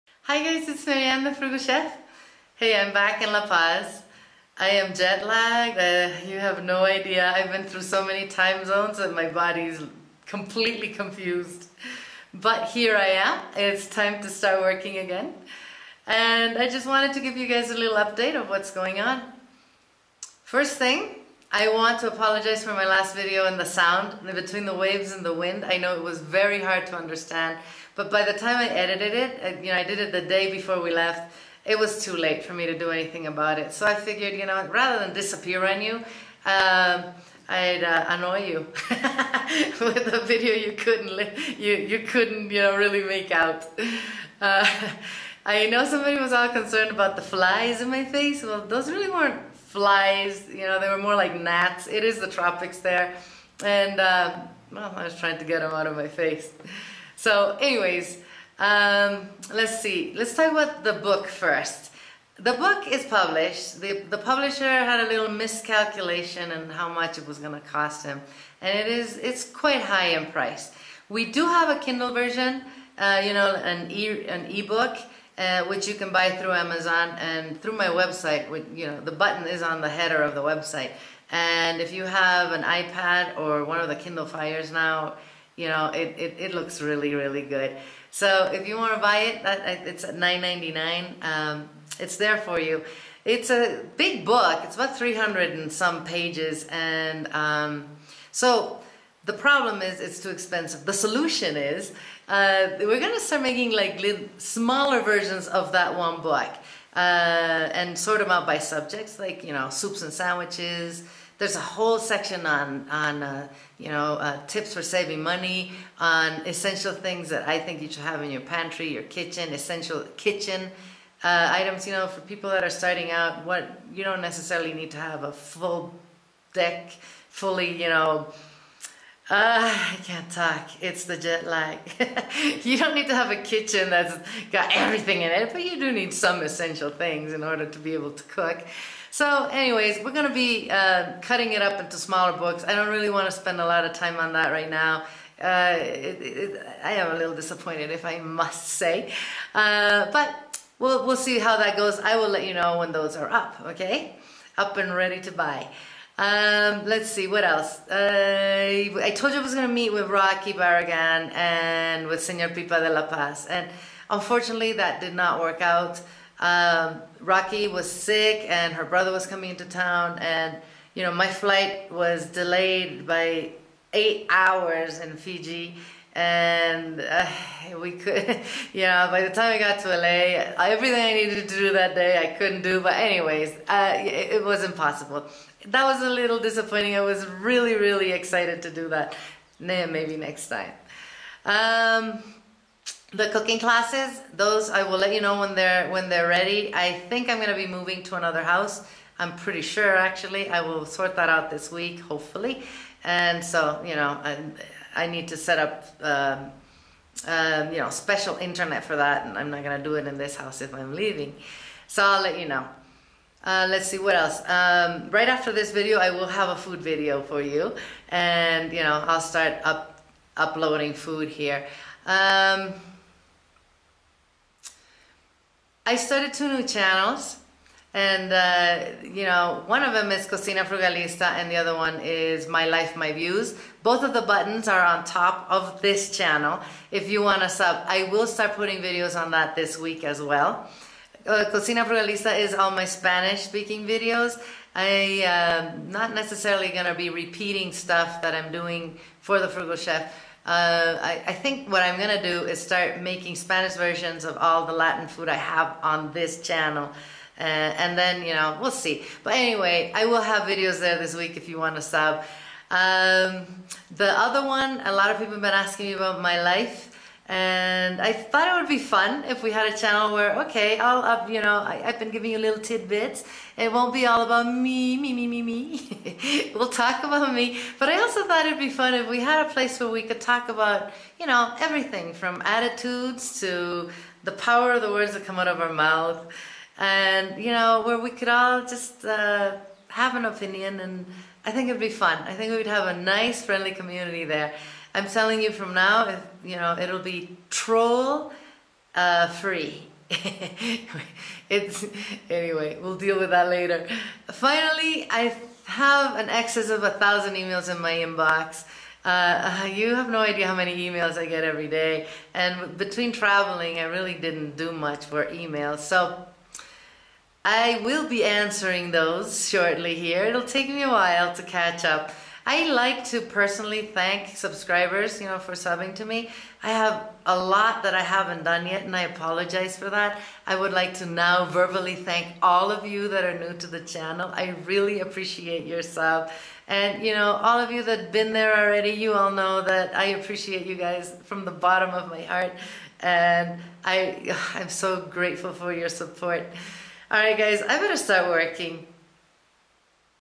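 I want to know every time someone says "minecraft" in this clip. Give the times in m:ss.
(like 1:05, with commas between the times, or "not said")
not said.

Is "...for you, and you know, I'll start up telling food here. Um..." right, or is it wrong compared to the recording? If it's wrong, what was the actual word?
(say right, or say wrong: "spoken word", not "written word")
wrong: "uploading", not "telling".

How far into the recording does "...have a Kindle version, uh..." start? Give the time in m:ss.
1:11.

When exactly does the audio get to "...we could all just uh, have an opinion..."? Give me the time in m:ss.
4:47.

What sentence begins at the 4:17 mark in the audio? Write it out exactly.
Uh, and then, you know, we'll see.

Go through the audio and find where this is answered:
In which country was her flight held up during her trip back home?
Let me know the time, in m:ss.
2:55.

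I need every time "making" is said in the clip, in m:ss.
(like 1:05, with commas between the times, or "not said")
1:43, 4:13.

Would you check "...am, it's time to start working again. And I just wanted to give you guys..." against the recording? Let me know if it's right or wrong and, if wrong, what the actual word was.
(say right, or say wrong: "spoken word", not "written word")
right.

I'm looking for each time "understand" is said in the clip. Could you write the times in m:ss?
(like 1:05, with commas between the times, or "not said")
0:26.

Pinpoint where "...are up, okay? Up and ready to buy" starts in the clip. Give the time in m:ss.
2:33.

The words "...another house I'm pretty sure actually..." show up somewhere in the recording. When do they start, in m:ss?
3:18.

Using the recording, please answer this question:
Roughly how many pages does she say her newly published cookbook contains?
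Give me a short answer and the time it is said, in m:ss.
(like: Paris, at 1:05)
300 and some, at 1:34.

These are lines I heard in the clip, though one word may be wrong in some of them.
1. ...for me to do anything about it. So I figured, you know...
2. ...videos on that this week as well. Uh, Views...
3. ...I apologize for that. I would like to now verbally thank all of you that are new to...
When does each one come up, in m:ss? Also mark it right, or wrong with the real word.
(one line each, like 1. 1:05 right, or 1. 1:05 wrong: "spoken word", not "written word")
1. 0:32 right
2. 3:58 wrong: "Cocina", not "Views"
3. 5:28 right.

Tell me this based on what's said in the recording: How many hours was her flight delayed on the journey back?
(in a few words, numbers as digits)
8.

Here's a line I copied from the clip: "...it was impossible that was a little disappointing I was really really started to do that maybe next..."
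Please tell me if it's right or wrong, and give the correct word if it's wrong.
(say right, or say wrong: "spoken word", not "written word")
wrong: "excited", not "started".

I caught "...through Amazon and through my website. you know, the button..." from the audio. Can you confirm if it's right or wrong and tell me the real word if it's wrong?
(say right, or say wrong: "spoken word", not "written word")
right.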